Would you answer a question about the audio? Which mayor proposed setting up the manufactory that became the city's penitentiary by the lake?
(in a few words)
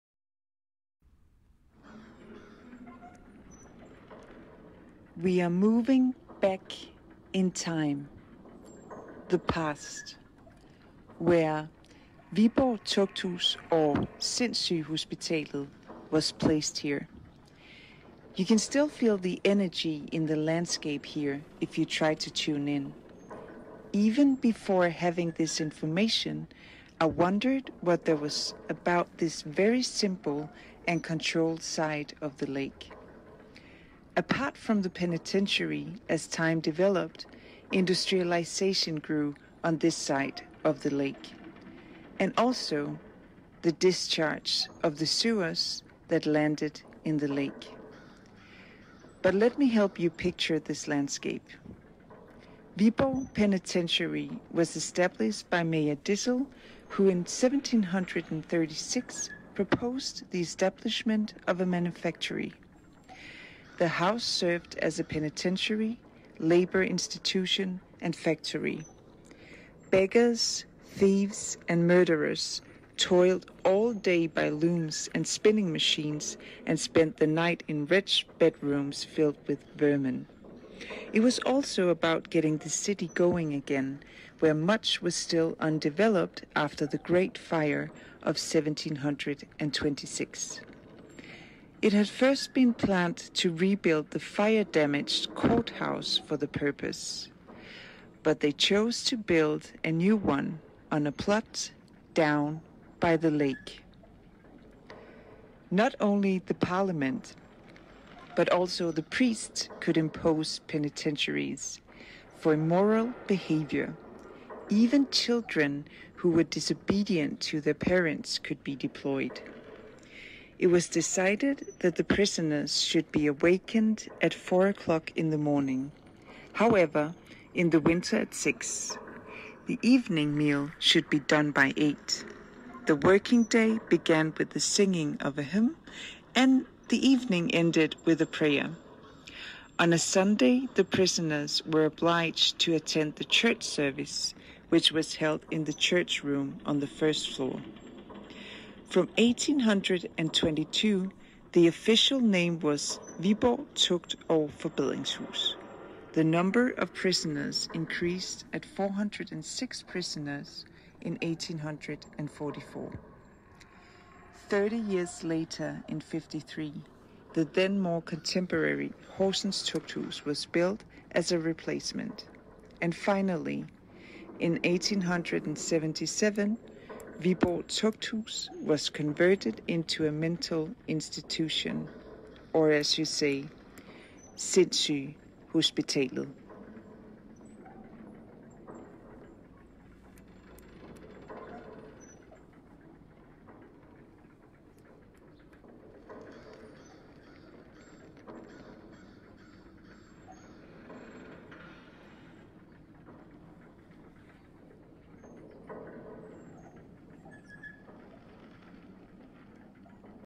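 Dissel.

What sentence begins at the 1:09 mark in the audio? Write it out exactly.
Beggars, thieves, and murderers toiled all day by looms and spinning machines and spent the night in wretched bedrooms filled with vermin.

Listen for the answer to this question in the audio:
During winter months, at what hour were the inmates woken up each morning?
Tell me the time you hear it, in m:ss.
2:08.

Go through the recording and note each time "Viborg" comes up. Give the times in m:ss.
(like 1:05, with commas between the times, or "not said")
0:12, 0:52, 2:33, 2:57.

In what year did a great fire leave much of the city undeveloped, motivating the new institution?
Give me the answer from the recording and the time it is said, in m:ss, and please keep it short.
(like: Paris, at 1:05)
1726, at 1:28.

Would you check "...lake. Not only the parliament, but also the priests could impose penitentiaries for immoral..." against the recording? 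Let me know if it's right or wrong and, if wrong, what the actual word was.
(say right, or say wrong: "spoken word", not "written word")
right.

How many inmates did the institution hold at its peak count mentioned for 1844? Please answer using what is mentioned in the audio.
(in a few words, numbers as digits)
406.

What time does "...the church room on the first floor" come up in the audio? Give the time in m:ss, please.
2:25.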